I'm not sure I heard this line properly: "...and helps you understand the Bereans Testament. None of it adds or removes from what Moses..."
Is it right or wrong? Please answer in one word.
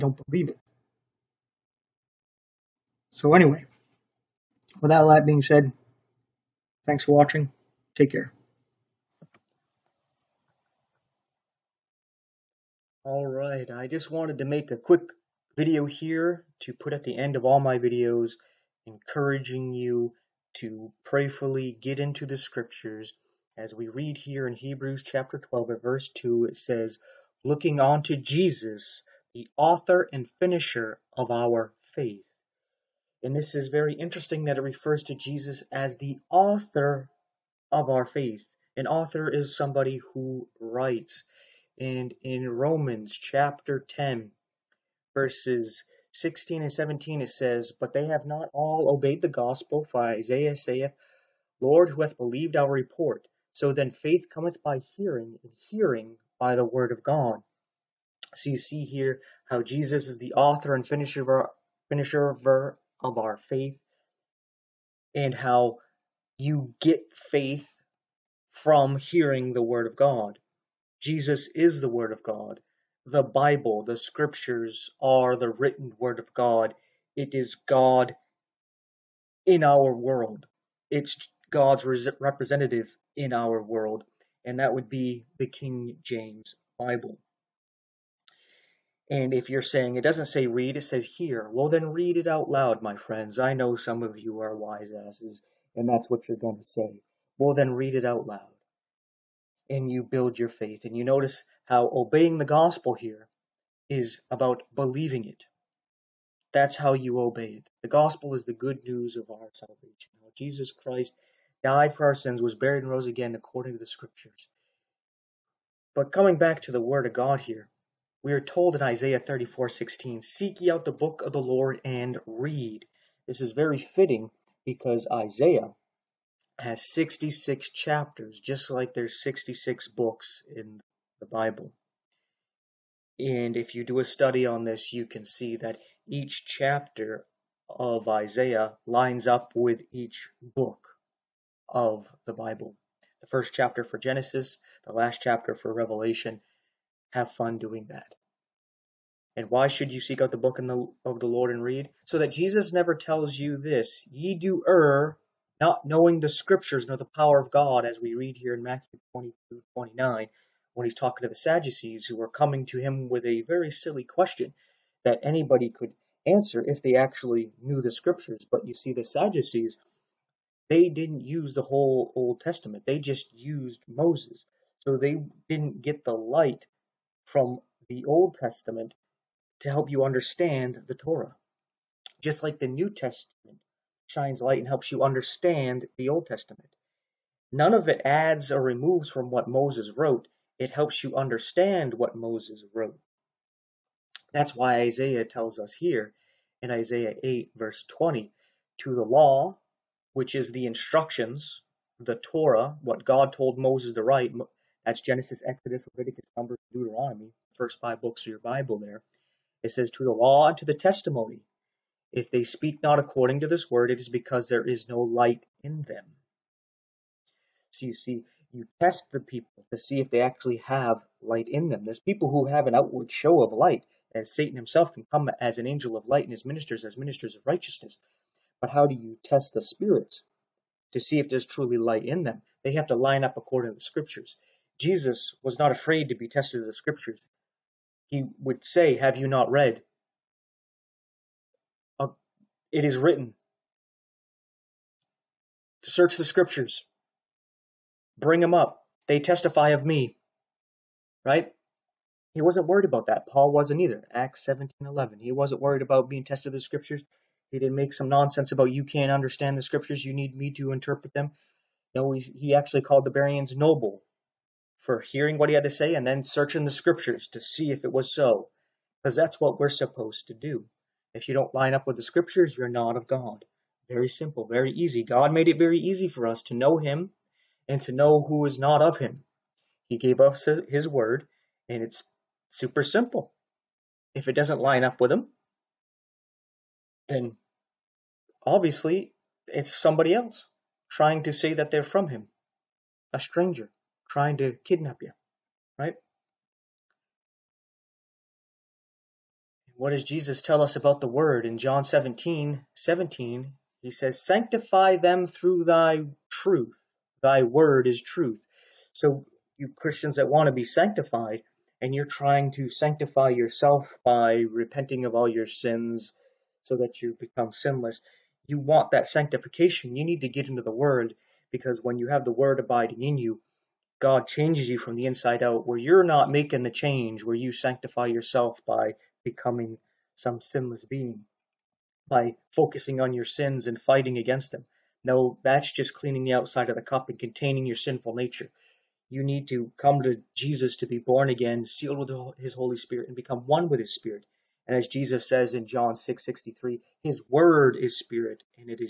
wrong.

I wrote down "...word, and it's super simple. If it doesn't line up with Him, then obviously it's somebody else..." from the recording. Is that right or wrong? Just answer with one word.
right.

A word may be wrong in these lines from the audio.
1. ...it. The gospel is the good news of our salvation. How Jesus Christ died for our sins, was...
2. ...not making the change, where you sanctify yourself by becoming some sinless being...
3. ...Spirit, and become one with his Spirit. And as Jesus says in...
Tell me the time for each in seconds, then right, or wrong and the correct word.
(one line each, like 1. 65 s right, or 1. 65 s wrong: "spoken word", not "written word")
1. 107 s right
2. 326 s right
3. 342 s right.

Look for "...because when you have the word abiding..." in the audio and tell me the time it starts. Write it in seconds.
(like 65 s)
321 s.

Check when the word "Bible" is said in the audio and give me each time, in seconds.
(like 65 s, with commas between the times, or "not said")
73 s, 86 s, 131 s, 142 s, 208 s.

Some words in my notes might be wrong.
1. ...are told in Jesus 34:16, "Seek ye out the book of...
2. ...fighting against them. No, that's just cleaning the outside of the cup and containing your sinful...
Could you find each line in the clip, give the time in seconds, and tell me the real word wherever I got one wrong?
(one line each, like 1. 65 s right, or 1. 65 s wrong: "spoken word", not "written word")
1. 118 s wrong: "Isaiah", not "Jesus"
2. 333 s right.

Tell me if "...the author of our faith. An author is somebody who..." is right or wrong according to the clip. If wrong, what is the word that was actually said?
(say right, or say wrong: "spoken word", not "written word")
right.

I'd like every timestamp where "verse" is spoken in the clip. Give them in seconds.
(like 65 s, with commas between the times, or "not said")
25 s, 45 s, 197 s.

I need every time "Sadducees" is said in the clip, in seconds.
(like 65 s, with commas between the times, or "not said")
161 s, 169 s.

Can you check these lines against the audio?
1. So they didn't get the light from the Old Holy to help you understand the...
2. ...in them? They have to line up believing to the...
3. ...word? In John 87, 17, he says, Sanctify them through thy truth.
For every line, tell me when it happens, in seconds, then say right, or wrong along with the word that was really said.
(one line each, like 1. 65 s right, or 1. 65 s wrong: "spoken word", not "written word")
1. 174 s wrong: "Testament", not "Holy"
2. 232 s wrong: "according", not "believing"
3. 301 s wrong: "17", not "87".